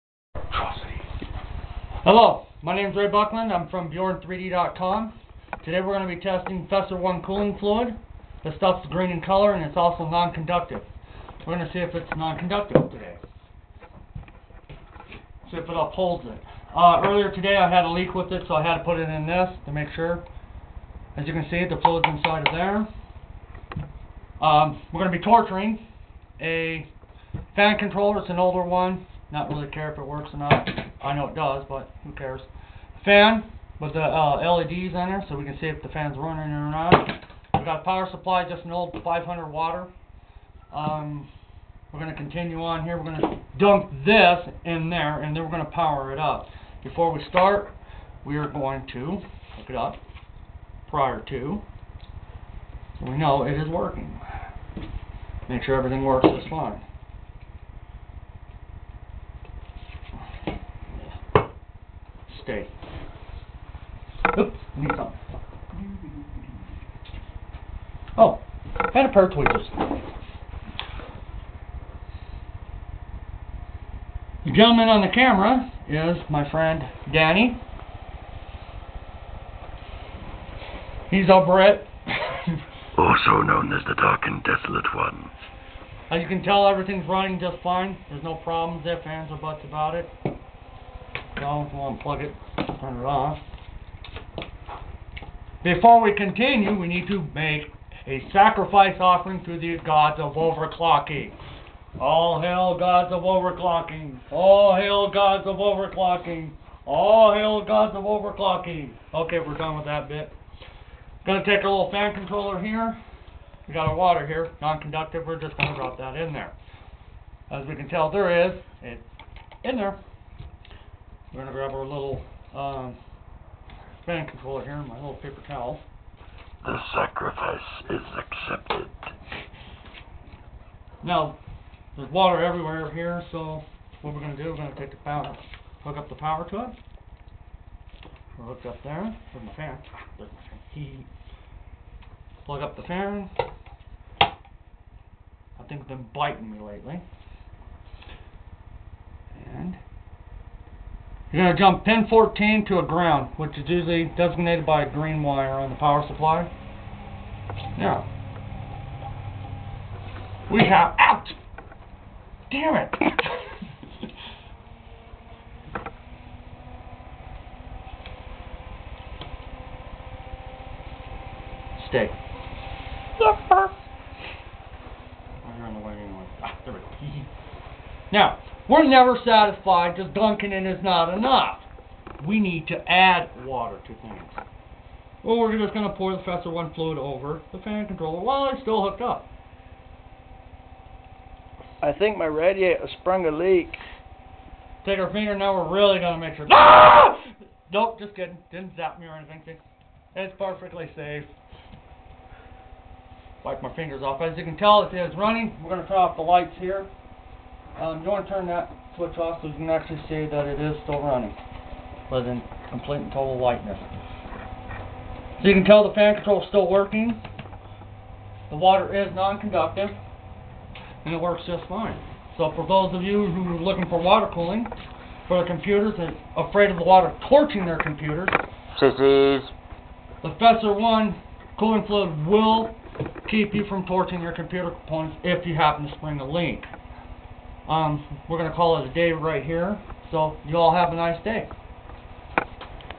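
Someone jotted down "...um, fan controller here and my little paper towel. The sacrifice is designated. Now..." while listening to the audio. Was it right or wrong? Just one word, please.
wrong.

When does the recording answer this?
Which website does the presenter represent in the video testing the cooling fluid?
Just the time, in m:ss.
0:03.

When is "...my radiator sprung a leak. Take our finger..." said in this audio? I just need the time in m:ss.
3:12.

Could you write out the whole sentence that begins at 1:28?
There's no problems, if, ands, or buts about it down, we'll unplug it, turn it off.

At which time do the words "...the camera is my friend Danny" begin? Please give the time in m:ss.
1:15.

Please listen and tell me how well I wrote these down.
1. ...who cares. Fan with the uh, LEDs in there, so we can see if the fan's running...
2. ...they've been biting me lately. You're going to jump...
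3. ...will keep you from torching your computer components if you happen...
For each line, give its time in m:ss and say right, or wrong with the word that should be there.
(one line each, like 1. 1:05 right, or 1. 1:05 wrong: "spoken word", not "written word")
1. 0:32 right
2. 2:25 right
3. 3:52 right.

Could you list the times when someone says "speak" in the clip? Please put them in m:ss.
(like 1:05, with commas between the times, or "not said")
not said.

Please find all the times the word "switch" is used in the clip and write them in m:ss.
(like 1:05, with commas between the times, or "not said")
3:28.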